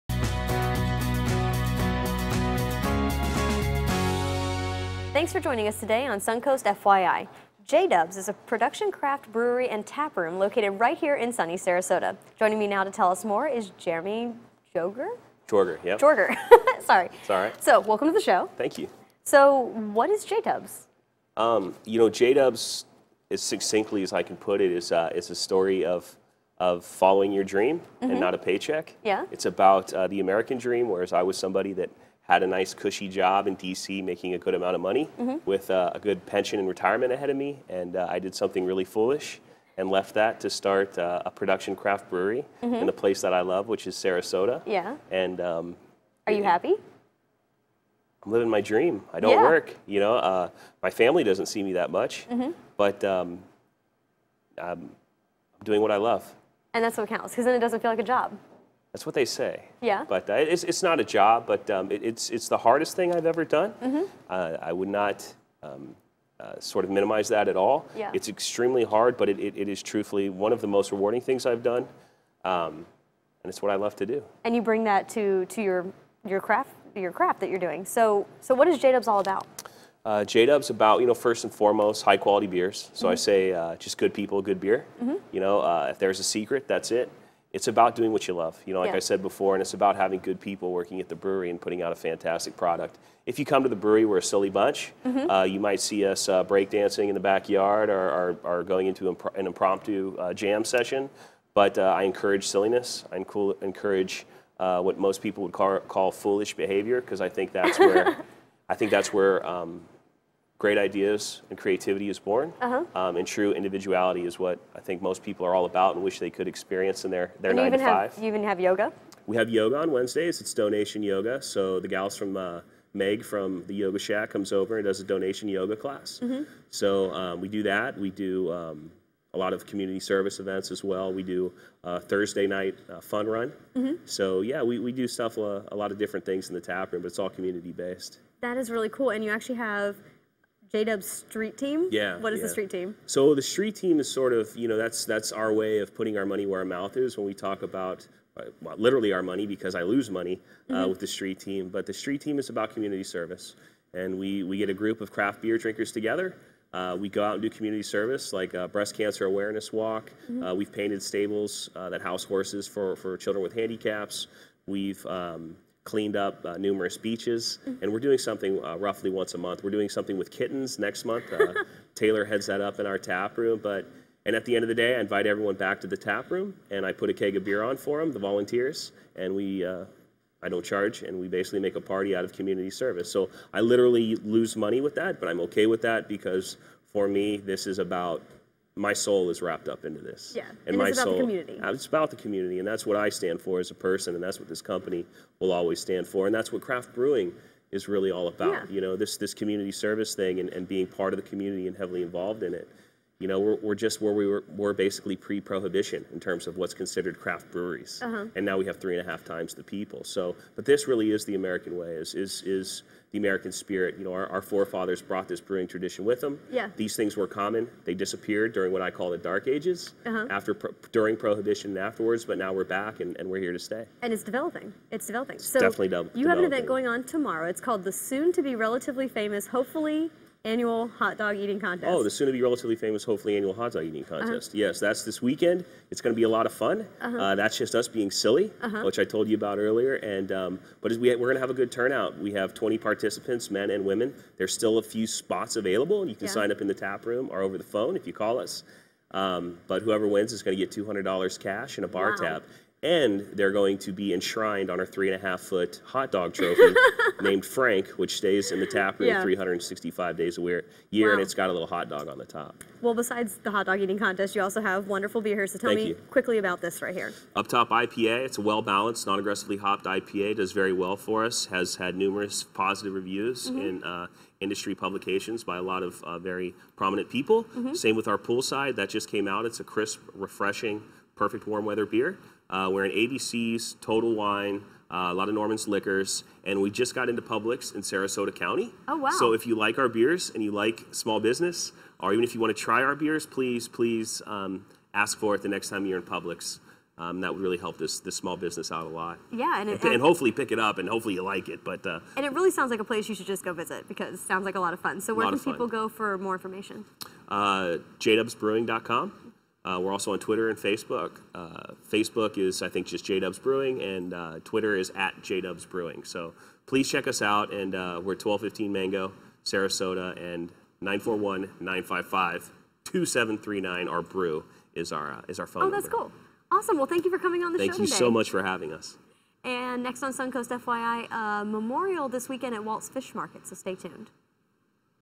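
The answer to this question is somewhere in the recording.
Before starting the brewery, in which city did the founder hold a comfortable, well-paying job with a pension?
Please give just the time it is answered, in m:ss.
0:33.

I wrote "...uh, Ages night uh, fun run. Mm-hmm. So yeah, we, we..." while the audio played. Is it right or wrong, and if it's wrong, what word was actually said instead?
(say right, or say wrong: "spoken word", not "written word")
wrong: "Thursday", not "Ages".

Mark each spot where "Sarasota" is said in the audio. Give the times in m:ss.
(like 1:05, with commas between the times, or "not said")
0:11, 0:44, 4:47, 5:19.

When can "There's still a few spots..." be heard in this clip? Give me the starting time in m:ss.
4:04.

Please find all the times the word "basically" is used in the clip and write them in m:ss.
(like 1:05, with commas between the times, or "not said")
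3:01, 3:24.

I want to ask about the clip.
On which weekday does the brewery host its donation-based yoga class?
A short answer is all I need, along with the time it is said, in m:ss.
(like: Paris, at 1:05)
Wednesdays, at 1:59.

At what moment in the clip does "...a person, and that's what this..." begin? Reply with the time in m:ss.
3:13.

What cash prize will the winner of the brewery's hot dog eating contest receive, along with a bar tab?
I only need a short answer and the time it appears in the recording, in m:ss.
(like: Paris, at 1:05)
$200, at 4:11.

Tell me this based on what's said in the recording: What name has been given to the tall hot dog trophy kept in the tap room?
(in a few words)
Frank.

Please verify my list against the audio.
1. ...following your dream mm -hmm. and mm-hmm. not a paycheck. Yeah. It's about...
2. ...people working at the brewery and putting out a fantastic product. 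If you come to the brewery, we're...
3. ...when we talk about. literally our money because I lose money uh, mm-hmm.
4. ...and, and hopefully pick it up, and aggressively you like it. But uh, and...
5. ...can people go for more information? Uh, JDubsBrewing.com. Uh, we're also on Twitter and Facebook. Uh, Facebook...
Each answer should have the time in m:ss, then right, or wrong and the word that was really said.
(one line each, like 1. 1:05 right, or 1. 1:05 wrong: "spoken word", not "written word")
1. 0:26 right
2. 1:30 right
3. 2:27 right
4. 4:59 wrong: "hopefully", not "aggressively"
5. 5:05 right.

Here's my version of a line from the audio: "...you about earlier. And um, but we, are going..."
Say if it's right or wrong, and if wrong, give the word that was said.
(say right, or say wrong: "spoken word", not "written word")
right.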